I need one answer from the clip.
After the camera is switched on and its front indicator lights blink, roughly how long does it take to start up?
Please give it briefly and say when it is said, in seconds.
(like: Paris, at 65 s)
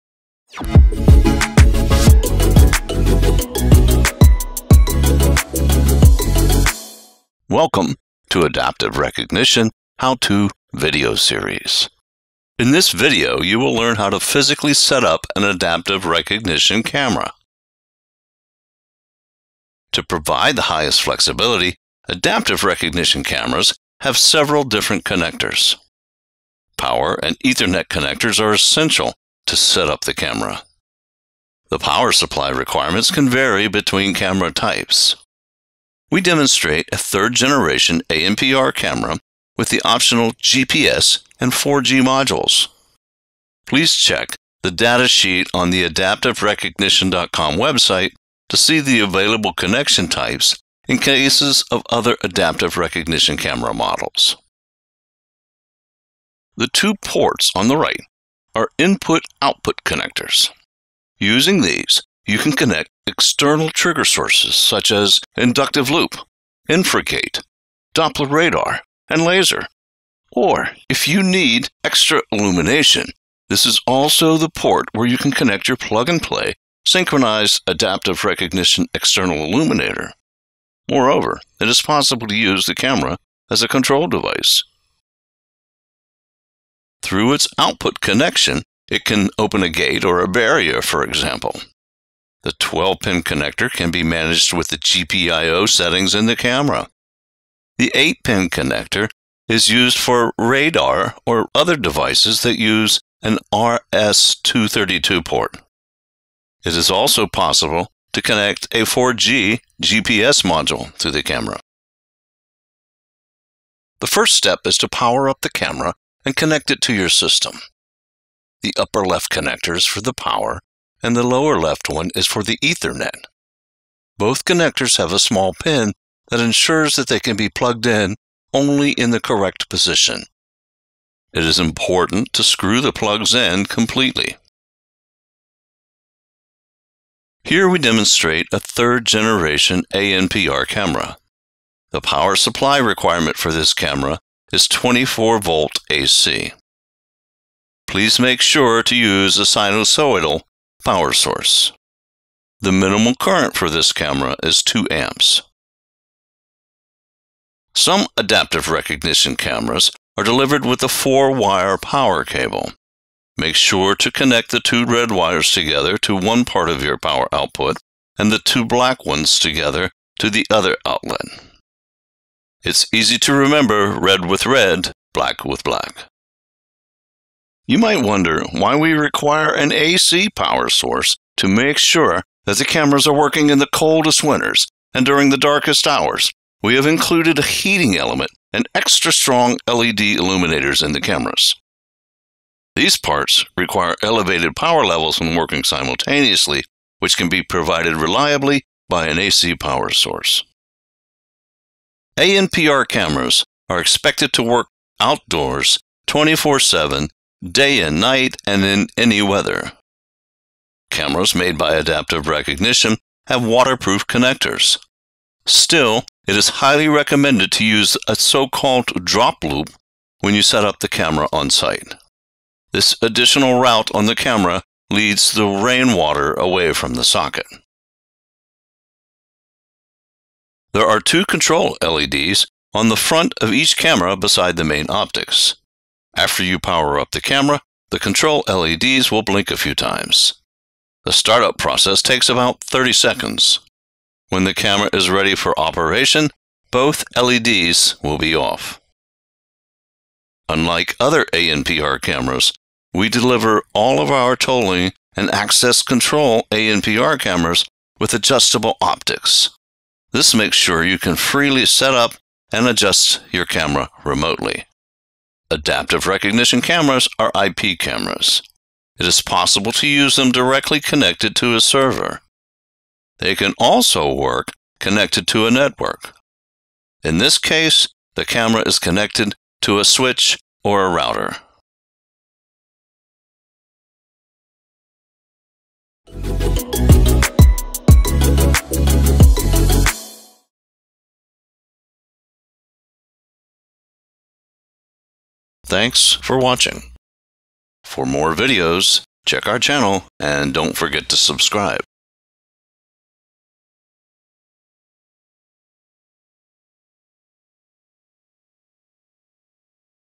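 30 seconds, at 242 s.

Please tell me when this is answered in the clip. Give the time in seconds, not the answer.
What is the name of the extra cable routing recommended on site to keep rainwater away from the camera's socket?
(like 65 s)
219 s.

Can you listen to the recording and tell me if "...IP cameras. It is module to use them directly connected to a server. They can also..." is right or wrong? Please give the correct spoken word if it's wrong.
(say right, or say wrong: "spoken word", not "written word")
wrong: "possible", not "module".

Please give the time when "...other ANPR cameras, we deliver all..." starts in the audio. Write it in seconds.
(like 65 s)
251 s.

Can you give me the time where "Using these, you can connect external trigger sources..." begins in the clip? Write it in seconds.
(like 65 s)
61 s.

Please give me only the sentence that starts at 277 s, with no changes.
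In this case, the camera is connected to a switch or a router.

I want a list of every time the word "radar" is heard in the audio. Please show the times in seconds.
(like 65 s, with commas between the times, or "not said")
68 s, 100 s.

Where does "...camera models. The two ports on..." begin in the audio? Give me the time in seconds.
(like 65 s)
53 s.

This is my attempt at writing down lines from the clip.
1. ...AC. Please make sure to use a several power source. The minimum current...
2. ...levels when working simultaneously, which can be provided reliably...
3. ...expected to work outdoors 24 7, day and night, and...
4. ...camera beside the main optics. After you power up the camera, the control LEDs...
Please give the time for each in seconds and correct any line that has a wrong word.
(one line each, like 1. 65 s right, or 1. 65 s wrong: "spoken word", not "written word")
1. 145 s wrong: "sinusoidal", not "several"
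2. 194 s right
3. 203 s right
4. 233 s right.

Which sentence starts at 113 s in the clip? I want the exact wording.
The first step is to power up the camera and connect it to your system.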